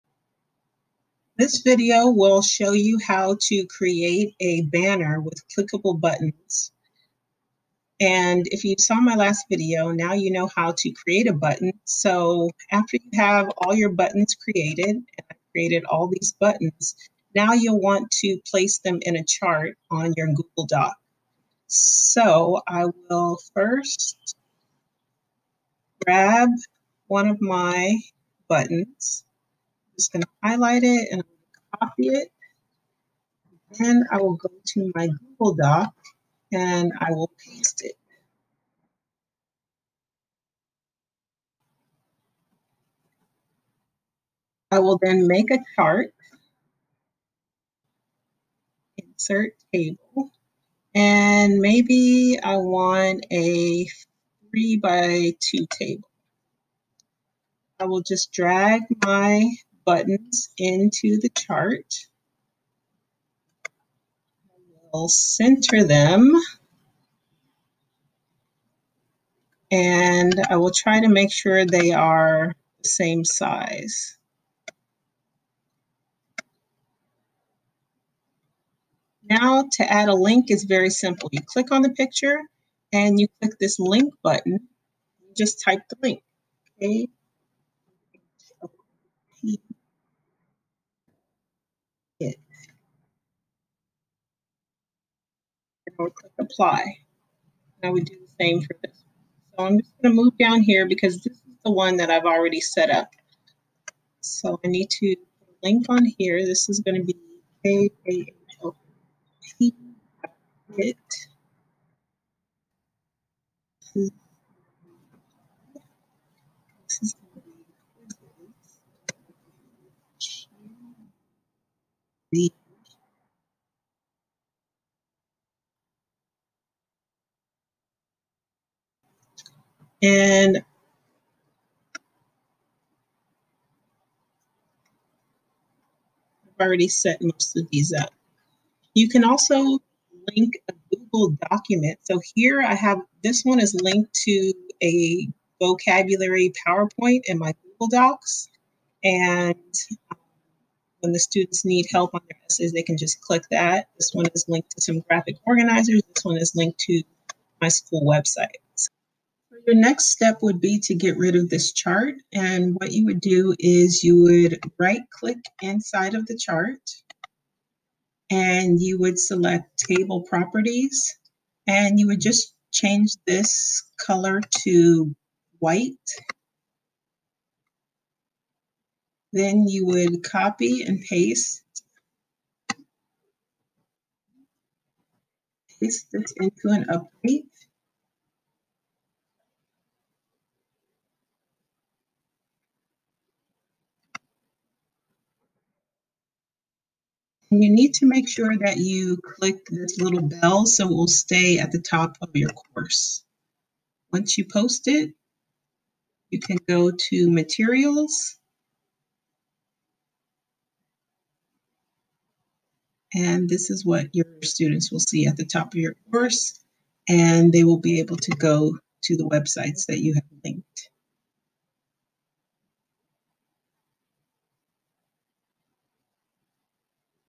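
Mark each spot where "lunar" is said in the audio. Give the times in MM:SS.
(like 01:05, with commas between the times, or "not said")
not said.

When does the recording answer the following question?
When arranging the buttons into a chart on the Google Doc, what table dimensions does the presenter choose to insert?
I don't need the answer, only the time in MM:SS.
00:54.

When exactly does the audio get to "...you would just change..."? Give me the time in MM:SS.
02:51.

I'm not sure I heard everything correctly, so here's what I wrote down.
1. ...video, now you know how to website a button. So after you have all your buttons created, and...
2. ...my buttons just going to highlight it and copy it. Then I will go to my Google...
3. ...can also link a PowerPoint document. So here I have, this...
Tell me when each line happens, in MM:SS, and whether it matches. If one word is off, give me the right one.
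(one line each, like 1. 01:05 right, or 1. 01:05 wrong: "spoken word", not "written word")
1. 00:09 wrong: "create", not "website"
2. 00:27 right
3. 02:19 wrong: "Google", not "PowerPoint".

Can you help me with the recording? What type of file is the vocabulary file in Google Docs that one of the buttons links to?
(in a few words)
PowerPoint.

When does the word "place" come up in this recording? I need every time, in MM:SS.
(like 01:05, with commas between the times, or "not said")
00:18.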